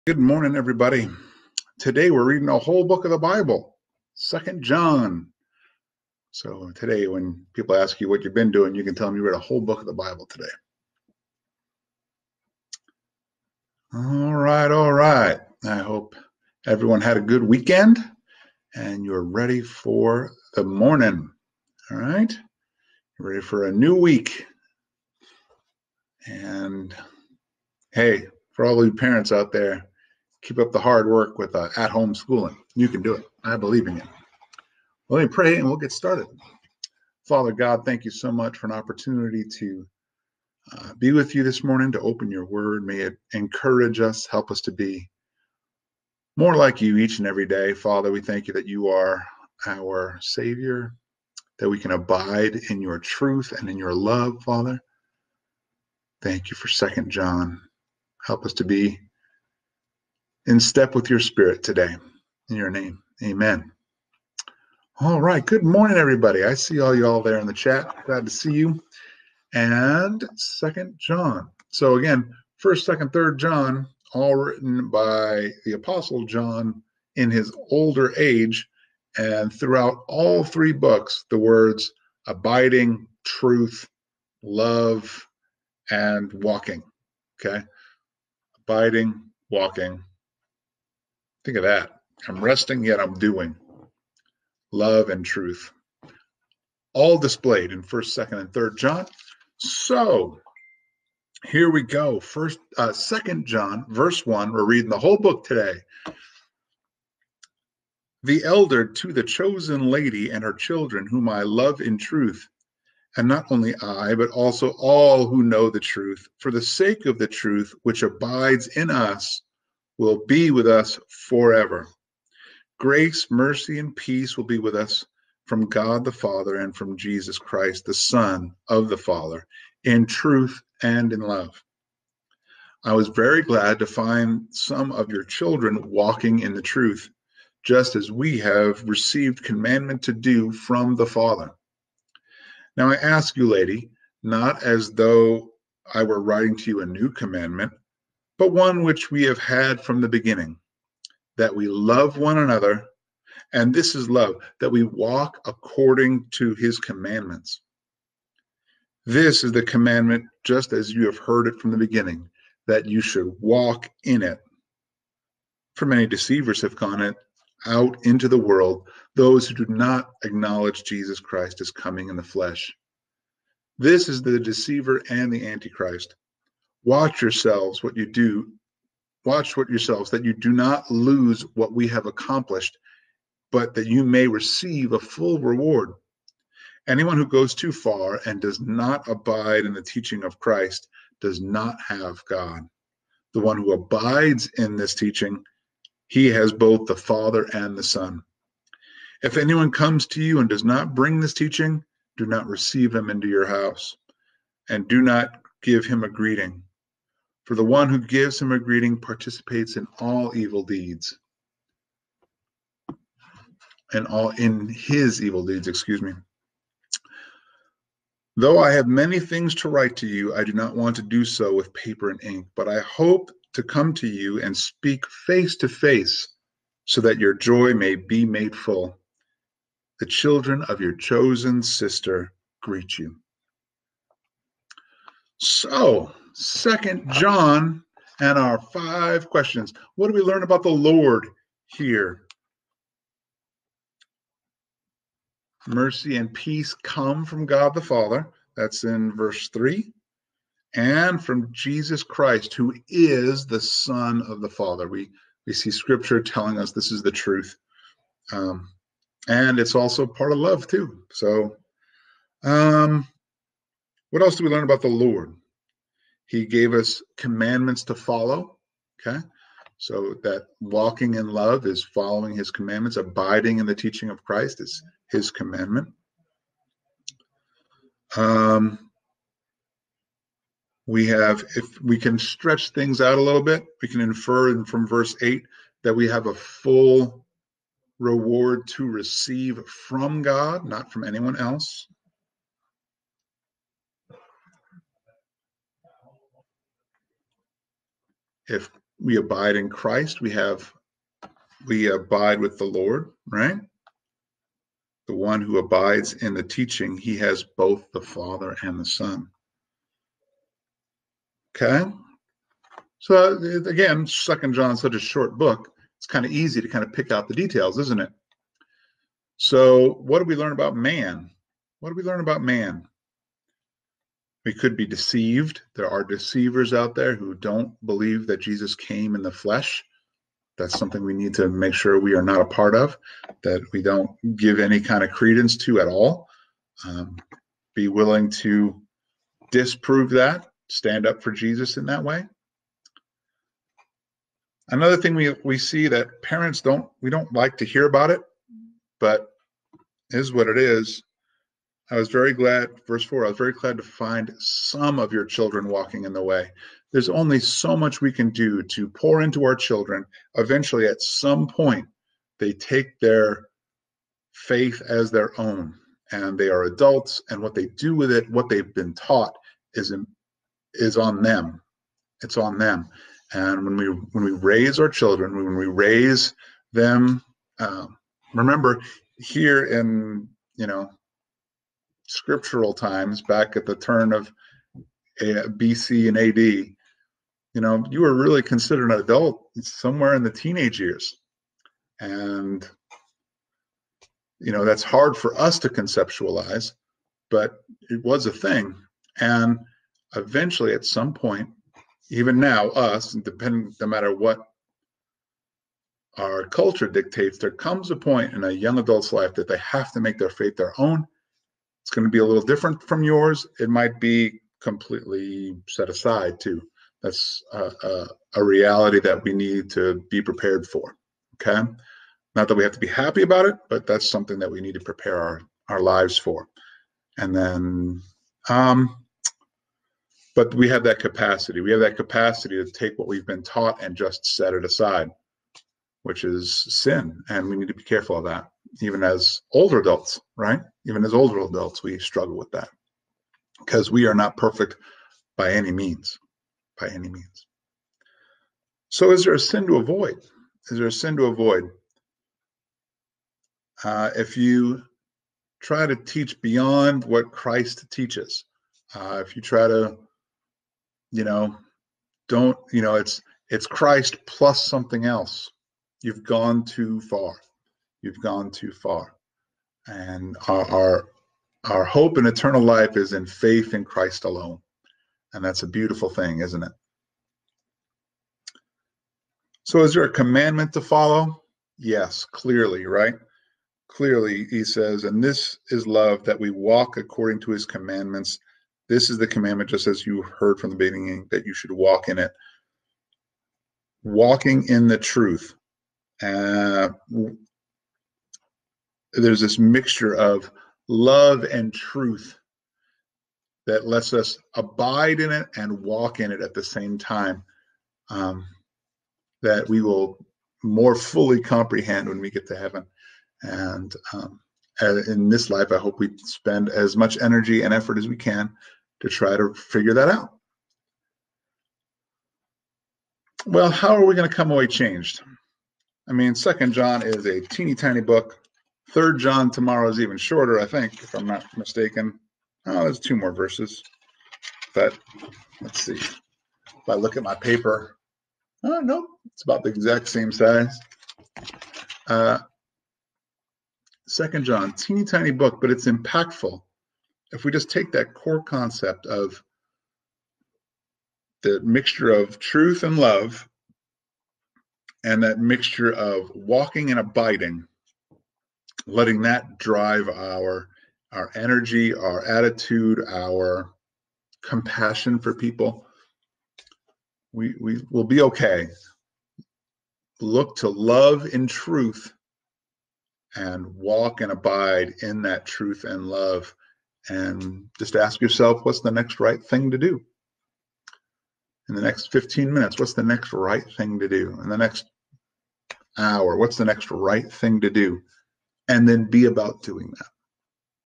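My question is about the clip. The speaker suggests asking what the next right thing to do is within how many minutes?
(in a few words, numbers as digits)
15 minutes.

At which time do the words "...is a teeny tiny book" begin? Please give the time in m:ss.
8:47.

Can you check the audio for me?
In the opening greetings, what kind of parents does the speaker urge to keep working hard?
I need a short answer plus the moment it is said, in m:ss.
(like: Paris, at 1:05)
Home schooling, at 0:31.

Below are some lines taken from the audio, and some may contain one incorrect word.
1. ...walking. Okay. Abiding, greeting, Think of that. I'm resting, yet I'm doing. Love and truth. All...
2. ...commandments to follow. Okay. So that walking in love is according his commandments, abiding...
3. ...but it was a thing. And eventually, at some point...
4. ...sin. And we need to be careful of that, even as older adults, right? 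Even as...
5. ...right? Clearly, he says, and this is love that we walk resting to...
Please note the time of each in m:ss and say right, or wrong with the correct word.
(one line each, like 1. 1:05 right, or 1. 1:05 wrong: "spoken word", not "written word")
1. 1:26 wrong: "walking", not "greeting"
2. 4:27 wrong: "following", not "according"
3. 6:37 right
4. 7:16 right
5. 8:02 wrong: "according", not "resting".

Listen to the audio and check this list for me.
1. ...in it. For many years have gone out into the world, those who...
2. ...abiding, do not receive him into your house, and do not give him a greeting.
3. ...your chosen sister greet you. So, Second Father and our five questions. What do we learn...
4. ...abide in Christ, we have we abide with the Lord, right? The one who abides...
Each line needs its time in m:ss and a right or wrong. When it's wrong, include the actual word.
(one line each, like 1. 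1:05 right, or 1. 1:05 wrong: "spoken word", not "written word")
1. 2:44 wrong: "deceivers", not "years"
2. 3:21 wrong: "teaching", not "abiding"
3. 3:50 wrong: "John", not "Father"
4. 4:59 right.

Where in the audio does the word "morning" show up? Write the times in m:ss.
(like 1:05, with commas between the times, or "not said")
0:00, 0:20, 0:41, 1:05.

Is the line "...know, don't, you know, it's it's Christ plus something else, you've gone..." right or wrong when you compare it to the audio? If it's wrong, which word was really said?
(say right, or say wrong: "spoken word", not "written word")
right.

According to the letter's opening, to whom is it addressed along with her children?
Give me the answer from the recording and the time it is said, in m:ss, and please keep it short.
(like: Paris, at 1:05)
The chosen lady, at 1:49.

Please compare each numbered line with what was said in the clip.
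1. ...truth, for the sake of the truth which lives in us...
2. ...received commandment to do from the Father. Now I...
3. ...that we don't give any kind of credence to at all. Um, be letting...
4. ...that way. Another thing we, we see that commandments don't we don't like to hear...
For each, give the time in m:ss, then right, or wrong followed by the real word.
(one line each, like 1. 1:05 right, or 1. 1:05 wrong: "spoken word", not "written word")
1. 1:55 wrong: "abides", not "lives"
2. 2:18 right
3. 5:33 wrong: "willing", not "letting"
4. 5:41 wrong: "parents", not "commandments".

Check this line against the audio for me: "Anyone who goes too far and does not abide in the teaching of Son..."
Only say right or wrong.
wrong.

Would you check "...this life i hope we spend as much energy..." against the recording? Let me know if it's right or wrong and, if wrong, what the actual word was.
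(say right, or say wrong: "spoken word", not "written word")
right.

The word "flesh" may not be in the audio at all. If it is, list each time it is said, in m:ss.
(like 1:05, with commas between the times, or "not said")
2:52, 5:29.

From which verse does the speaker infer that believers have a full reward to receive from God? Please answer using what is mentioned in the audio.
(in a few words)
Verse 8.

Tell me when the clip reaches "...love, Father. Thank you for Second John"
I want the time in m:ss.
0:53.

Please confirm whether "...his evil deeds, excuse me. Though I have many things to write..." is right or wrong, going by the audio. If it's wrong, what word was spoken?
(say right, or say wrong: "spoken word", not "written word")
right.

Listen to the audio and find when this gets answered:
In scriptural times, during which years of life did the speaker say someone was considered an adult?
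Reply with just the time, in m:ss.
6:30.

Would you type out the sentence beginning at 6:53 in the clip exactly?
It might be completely set aside too.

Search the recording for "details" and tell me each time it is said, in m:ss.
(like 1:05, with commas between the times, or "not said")
5:17.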